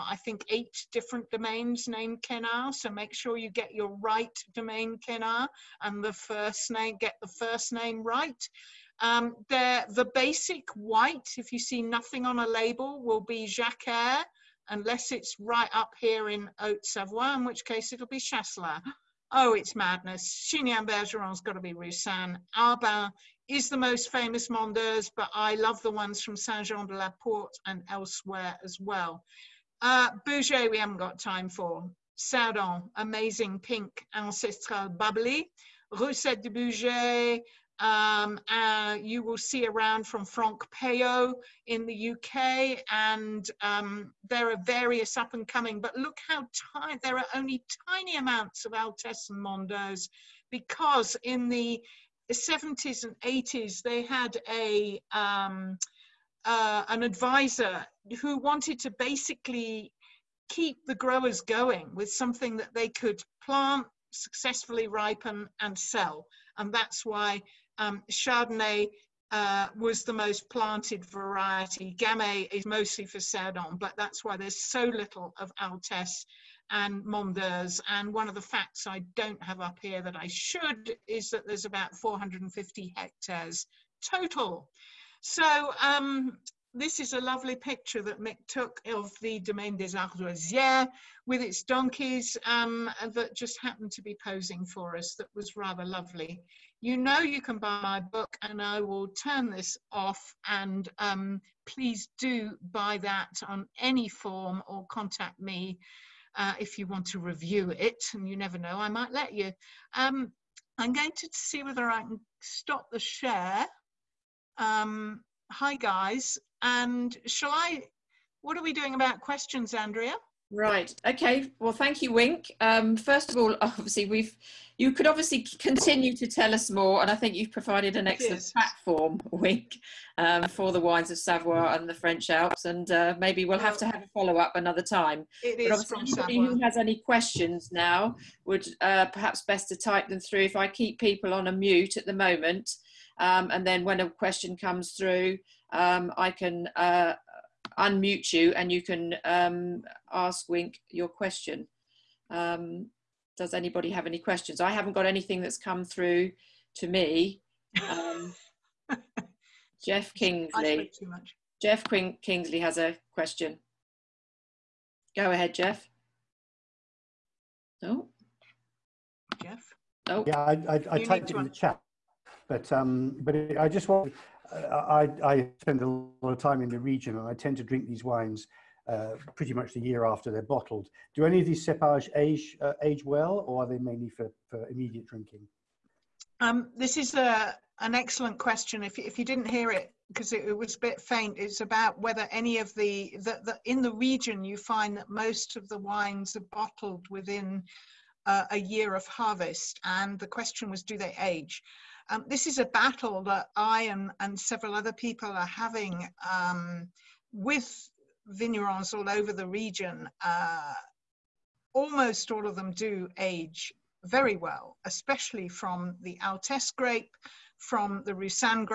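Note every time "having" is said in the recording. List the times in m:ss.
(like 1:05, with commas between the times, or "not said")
3:25.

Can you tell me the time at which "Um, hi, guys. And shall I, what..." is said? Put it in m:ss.
1:54.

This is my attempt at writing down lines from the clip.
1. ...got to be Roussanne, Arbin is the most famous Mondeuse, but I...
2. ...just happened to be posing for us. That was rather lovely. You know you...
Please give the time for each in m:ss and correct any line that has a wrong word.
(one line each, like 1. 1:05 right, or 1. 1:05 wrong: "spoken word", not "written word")
1. 0:21 right
2. 1:33 right.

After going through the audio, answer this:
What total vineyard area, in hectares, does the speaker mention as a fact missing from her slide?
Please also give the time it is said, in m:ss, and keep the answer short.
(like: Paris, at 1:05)
450 hectares, at 1:21.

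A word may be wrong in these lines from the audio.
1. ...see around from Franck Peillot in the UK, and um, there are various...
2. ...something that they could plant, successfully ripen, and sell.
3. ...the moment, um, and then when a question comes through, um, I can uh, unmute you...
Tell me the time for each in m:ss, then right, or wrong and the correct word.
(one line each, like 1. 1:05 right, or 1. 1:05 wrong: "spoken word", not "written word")
1. 0:39 right
2. 1:02 right
3. 2:22 right.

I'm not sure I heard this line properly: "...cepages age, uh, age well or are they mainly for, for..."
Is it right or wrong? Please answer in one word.
right.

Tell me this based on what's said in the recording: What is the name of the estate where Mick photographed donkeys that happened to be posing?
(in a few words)
Domaine des Ardoisiers.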